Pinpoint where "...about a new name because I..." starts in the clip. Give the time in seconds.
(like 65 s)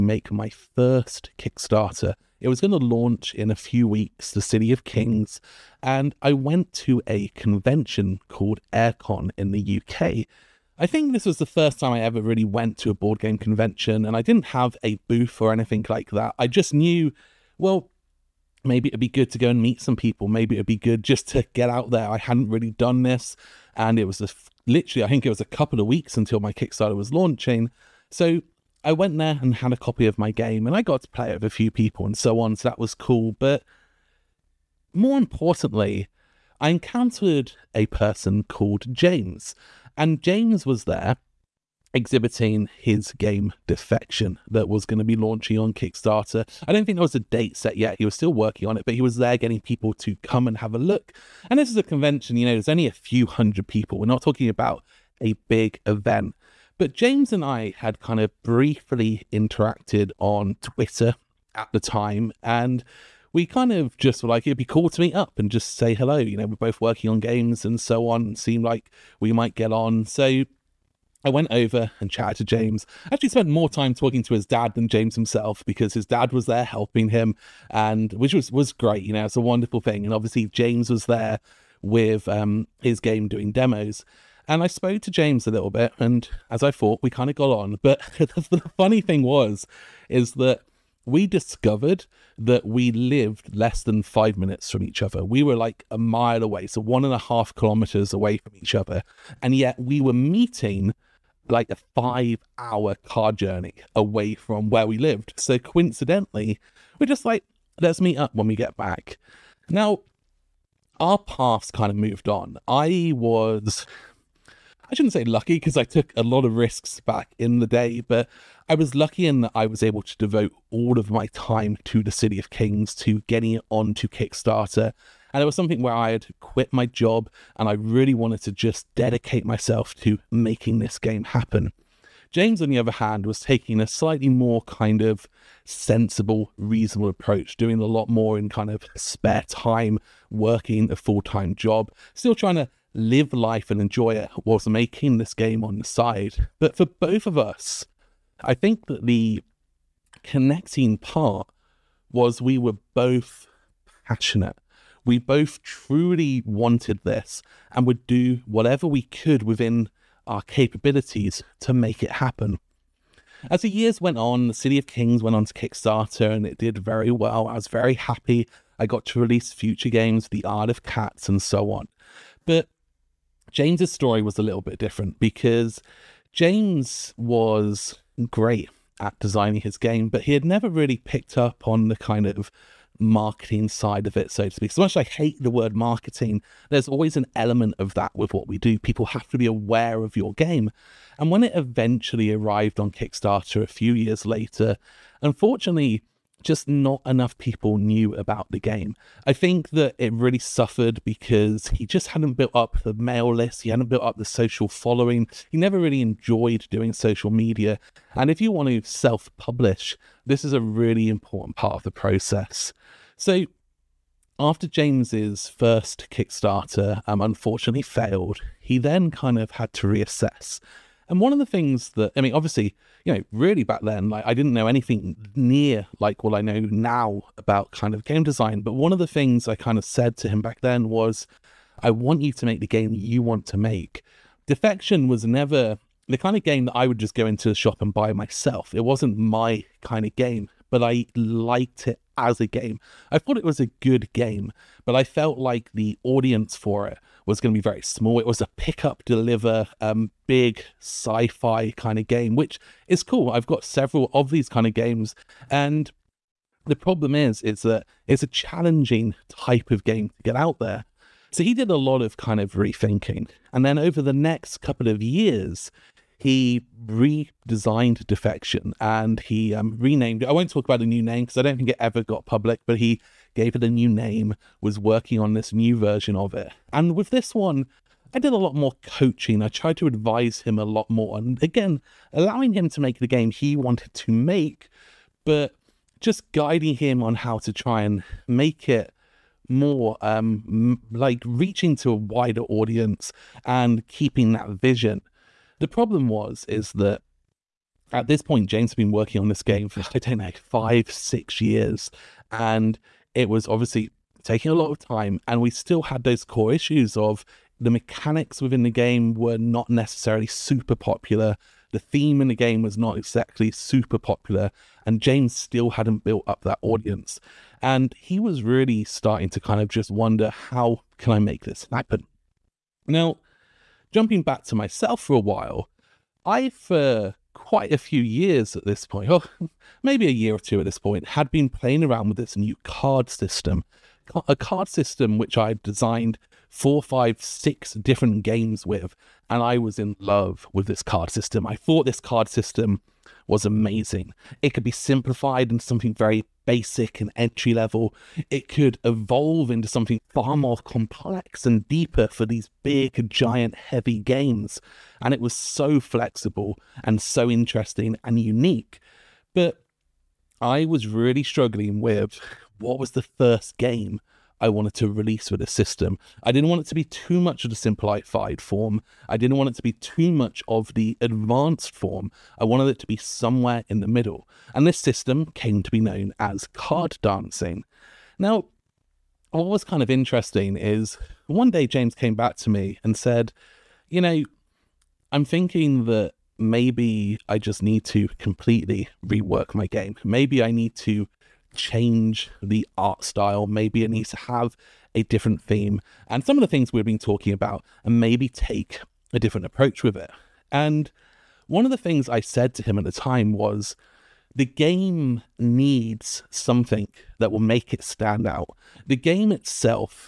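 270 s.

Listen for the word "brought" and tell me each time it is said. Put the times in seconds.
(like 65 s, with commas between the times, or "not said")
not said.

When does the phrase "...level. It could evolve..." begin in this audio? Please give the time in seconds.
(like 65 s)
347 s.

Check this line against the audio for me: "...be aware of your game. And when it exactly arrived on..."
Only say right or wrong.
wrong.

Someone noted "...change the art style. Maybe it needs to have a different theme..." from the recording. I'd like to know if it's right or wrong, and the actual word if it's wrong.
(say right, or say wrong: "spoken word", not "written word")
right.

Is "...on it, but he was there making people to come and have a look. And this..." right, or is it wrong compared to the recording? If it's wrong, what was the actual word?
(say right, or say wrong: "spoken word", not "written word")
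wrong: "getting", not "making".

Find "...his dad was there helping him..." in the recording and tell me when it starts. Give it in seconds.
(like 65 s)
75 s.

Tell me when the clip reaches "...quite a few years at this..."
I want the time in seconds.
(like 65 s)
327 s.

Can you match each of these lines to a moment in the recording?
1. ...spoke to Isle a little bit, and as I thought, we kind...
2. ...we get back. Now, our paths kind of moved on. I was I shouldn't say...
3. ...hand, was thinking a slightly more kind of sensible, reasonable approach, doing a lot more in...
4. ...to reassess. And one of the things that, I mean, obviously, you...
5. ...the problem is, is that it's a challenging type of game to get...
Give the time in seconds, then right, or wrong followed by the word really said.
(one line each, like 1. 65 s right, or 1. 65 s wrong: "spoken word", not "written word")
1. 84 s wrong: "James", not "Isle"
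2. 108 s right
3. 132 s wrong: "taking", not "thinking"
4. 219 s right
5. 256 s right.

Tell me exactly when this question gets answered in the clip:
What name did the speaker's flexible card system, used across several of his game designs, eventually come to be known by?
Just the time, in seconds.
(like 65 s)
376 s.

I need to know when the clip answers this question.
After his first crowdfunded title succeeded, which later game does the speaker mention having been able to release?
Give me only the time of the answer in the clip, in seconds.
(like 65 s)
170 s.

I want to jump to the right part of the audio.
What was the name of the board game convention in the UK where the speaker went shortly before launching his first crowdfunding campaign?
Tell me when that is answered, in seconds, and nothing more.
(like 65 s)
8 s.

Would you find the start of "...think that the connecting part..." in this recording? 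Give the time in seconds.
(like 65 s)
148 s.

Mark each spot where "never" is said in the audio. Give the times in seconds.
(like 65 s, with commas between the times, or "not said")
180 s, 205 s, 235 s.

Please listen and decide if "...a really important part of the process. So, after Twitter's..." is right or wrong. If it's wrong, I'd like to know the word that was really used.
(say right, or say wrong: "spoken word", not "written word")
wrong: "James", not "Twitter".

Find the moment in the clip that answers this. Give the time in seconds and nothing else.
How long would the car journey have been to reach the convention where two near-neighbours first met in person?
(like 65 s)
101 s.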